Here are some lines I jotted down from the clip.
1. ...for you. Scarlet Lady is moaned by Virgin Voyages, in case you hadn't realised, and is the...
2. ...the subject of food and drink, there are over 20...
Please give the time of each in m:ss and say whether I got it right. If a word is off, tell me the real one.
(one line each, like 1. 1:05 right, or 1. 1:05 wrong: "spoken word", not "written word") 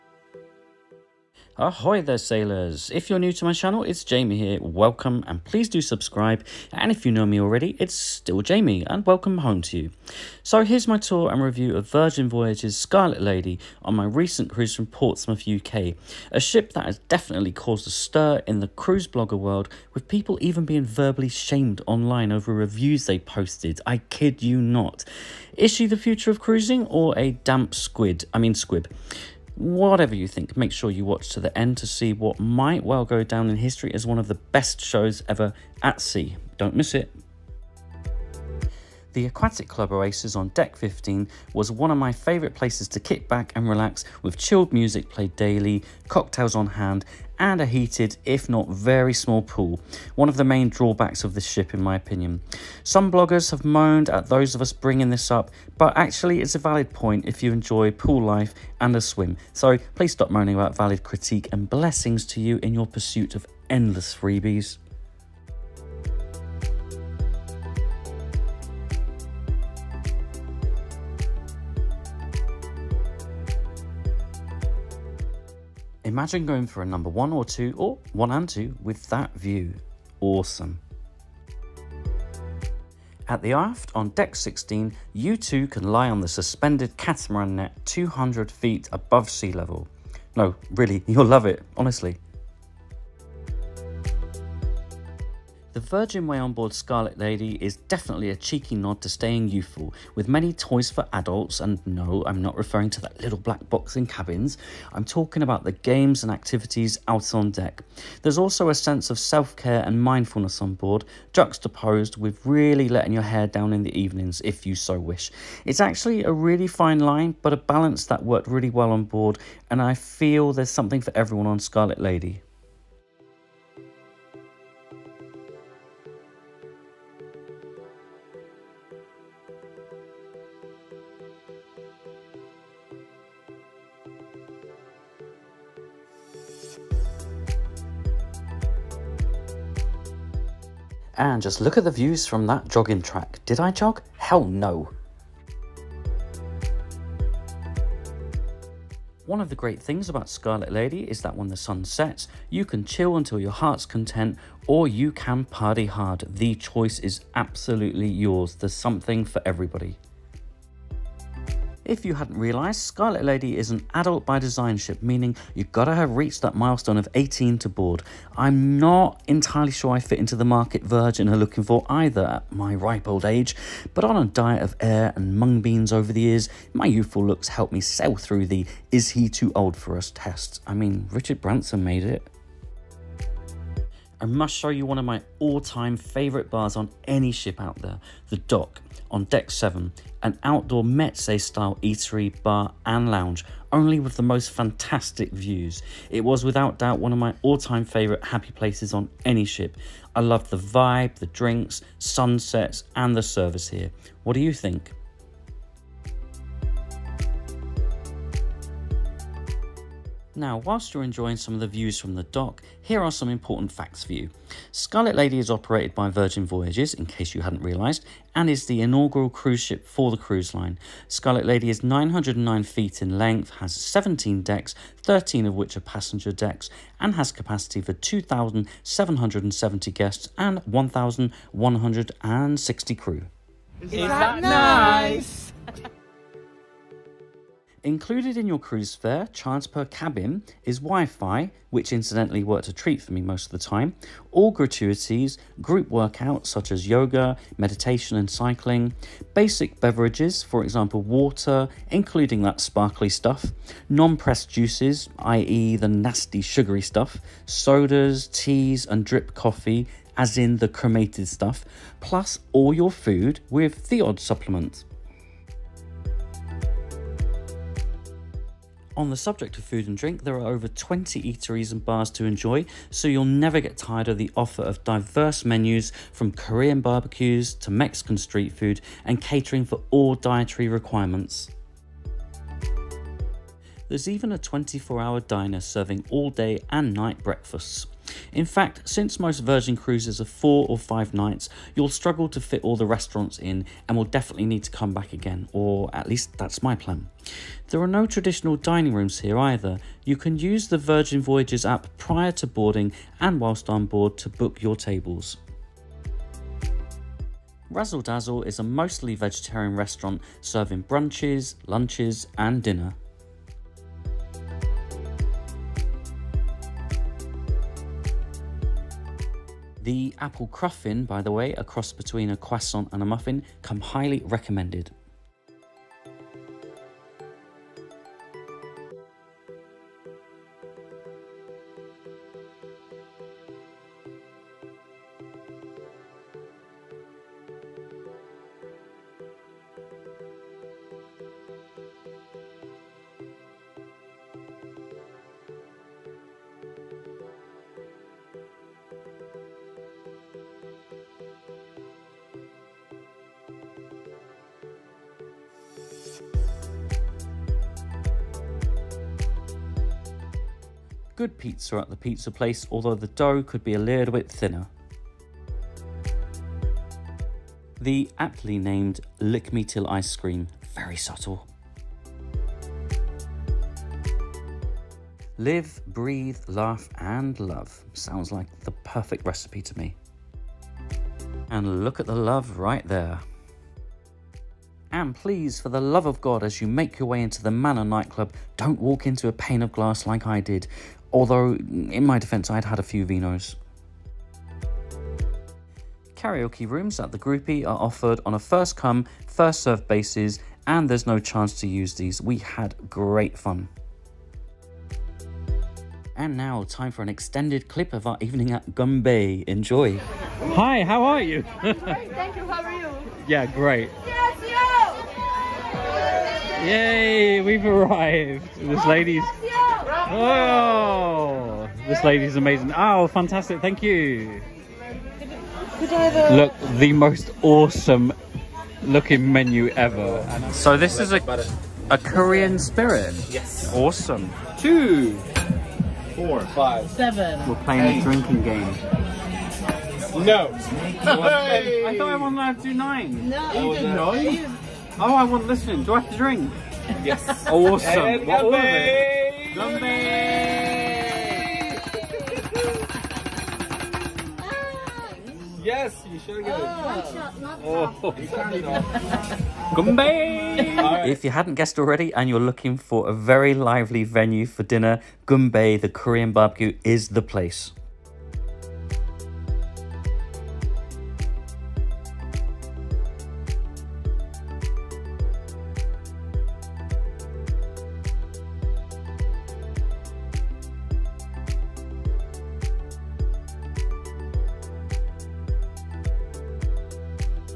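1. 3:34 wrong: "operated", not "moaned"
2. 4:29 right.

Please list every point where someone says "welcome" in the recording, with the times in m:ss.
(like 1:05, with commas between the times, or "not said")
0:04, 0:09.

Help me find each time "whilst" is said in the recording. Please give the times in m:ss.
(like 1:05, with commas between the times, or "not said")
3:30, 5:03.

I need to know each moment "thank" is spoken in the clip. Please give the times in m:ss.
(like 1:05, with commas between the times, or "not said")
6:51, 7:03.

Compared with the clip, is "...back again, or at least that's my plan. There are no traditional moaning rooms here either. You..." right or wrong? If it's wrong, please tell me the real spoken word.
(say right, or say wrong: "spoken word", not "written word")
wrong: "dining", not "moaning".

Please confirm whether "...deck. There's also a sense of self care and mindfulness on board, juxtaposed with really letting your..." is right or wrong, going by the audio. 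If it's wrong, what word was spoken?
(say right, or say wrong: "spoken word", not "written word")
right.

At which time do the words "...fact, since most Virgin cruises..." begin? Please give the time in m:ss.
4:48.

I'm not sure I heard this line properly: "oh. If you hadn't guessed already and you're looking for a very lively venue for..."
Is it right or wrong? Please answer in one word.
right.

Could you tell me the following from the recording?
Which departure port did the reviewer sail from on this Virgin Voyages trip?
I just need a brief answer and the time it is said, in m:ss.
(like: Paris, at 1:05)
Portsmouth, UK, at 0:14.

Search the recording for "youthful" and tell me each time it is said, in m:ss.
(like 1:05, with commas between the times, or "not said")
1:39, 2:56.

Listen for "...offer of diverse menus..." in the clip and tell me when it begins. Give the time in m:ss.
4:34.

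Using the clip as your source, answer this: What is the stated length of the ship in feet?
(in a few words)
909 feet.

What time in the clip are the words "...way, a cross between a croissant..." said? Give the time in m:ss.
5:21.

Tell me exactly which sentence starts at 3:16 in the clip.
It was without doubt one of my all-time favourite happy places on any ship.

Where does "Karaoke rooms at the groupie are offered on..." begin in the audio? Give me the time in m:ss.
6:36.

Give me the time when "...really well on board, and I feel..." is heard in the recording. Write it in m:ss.
1:58.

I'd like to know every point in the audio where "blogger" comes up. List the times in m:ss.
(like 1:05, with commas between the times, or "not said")
0:19, 0:53.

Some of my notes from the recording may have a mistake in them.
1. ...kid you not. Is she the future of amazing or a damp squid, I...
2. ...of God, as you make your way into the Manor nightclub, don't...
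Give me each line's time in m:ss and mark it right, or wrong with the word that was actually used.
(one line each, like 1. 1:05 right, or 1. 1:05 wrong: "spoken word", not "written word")
1. 0:23 wrong: "cruising", not "amazing"
2. 6:26 right.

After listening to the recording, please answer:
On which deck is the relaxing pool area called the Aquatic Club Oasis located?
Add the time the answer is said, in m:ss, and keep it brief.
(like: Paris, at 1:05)
Deck 15, at 0:40.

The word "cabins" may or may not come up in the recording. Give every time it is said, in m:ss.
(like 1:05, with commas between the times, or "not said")
1:44, 3:59.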